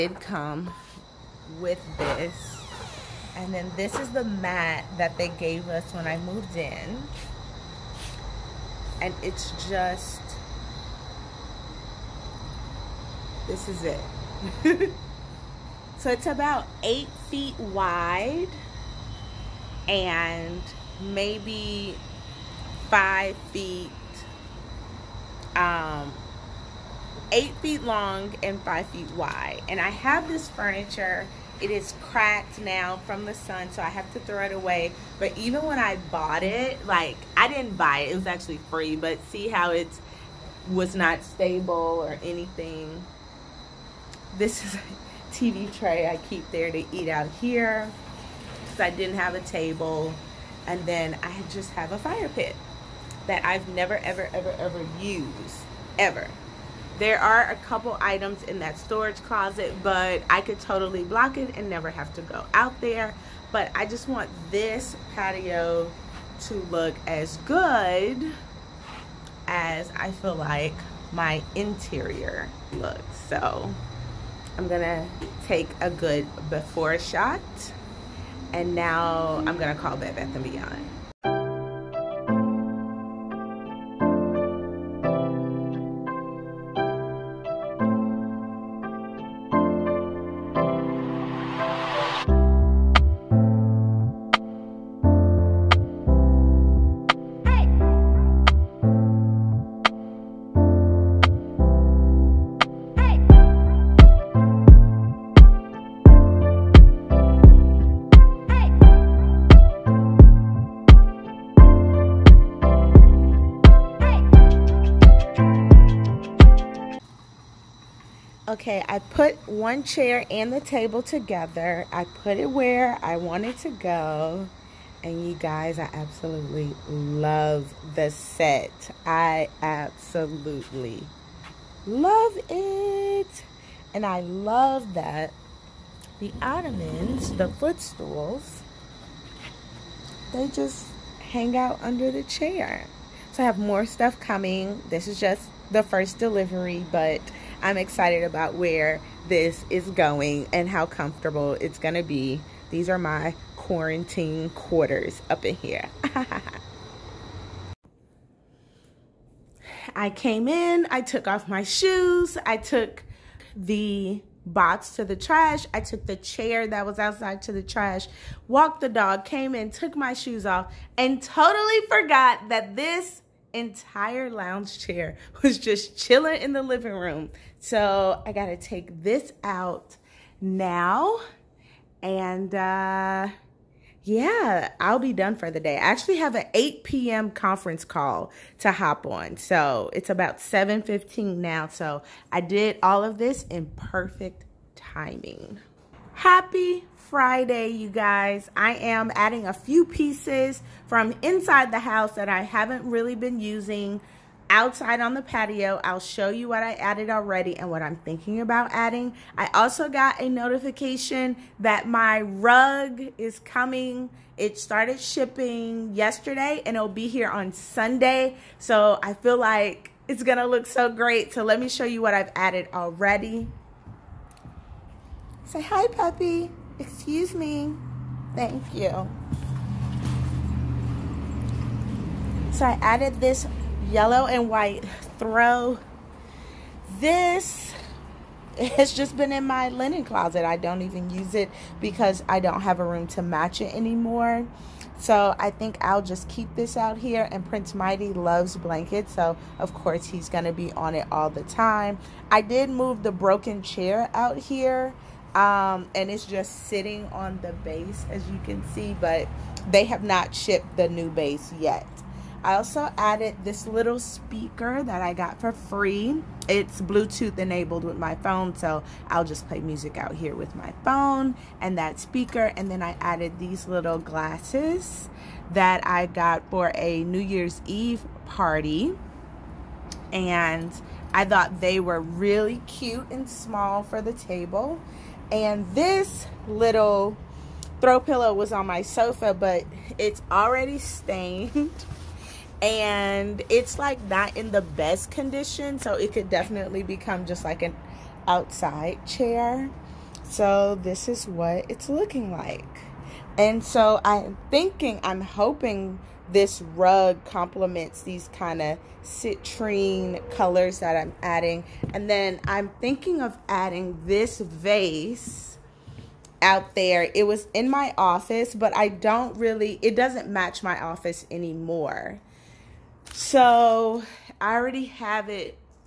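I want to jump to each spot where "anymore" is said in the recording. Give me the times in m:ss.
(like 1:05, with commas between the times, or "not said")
4:03, 5:21.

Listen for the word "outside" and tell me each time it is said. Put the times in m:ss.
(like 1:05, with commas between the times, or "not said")
2:46, 3:24, 4:58.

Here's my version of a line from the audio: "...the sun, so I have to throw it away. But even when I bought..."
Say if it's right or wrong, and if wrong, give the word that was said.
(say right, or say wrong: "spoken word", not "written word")
right.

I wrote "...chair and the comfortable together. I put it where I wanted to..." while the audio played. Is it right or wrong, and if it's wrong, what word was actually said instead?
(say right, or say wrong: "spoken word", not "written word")
wrong: "table", not "comfortable".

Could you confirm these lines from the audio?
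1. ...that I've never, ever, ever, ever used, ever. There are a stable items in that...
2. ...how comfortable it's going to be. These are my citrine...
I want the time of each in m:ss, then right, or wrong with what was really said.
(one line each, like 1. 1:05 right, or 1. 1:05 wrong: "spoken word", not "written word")
1. 0:53 wrong: "couple", not "stable"
2. 2:30 wrong: "quarantine", not "citrine".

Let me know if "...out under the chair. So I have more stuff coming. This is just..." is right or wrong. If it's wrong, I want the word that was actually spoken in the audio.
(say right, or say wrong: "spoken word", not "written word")
right.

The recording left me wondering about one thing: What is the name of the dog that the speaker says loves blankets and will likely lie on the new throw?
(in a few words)
Prince Mighty.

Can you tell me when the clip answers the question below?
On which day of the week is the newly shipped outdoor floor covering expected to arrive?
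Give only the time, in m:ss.
3:37.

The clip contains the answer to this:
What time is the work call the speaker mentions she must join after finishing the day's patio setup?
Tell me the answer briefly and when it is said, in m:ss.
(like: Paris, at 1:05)
8 p.m., at 3:06.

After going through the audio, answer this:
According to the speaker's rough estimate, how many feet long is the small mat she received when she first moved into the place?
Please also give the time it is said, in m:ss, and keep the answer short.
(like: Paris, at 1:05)
8, at 0:27.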